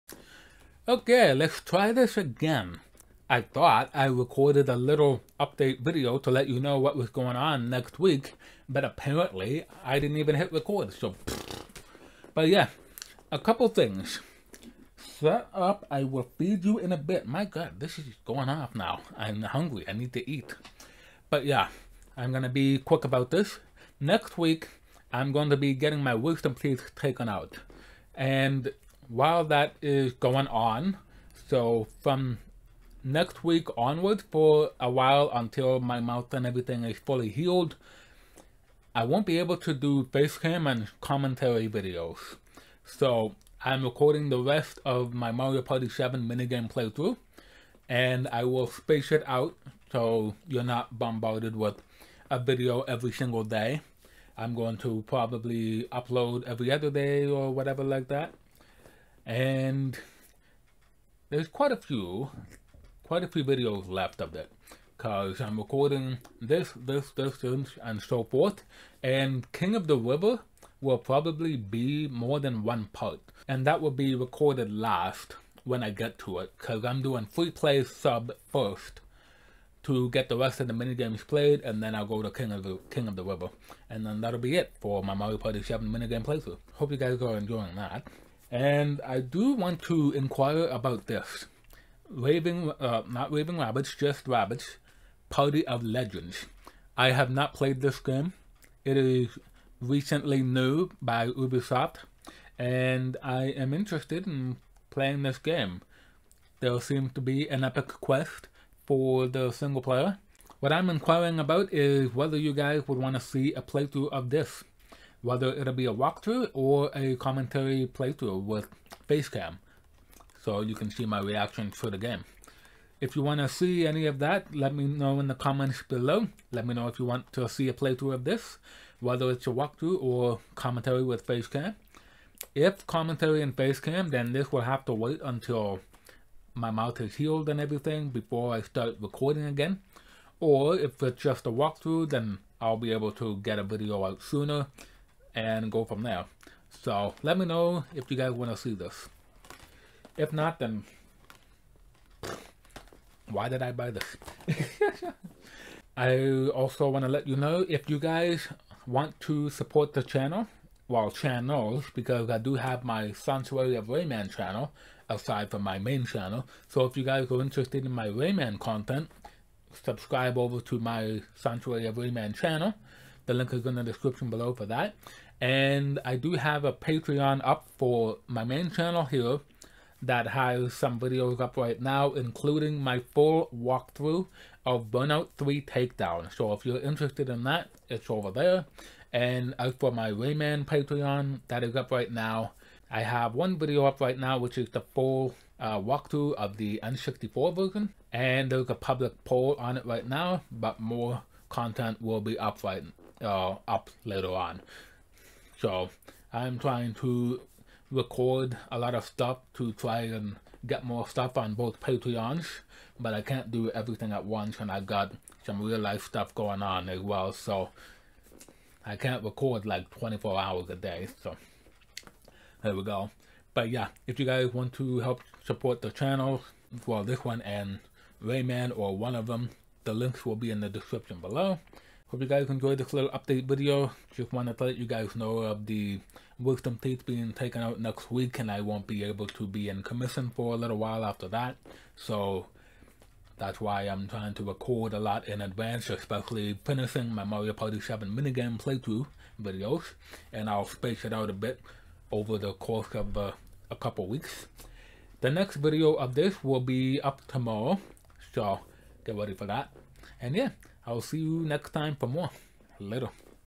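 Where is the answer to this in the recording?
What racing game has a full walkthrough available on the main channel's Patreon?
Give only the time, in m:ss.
3:04.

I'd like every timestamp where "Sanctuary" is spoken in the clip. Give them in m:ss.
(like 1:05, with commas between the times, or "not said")
2:43, 2:51.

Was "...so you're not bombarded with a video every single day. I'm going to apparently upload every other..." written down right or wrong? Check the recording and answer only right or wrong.
wrong.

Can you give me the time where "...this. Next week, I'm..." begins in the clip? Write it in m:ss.
0:23.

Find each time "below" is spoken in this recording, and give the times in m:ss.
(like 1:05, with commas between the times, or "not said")
2:05, 2:54, 3:51.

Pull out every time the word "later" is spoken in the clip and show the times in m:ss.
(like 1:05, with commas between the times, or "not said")
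3:24, 4:22.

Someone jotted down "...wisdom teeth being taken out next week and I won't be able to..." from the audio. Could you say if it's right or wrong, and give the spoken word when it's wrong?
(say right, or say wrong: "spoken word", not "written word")
right.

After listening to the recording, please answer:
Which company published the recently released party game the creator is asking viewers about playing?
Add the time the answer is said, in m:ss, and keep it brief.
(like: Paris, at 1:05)
Ubisoft, at 1:41.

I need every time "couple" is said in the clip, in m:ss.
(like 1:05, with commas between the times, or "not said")
0:13, 4:13.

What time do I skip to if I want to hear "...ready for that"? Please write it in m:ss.
4:19.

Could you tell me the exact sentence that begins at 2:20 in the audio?
Or if it's just a walkthrough, then I'll be able to get a video out sooner and go from there.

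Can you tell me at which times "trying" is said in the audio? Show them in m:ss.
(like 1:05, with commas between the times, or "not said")
3:26, 4:04.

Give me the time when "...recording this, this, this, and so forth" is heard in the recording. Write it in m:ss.
1:05.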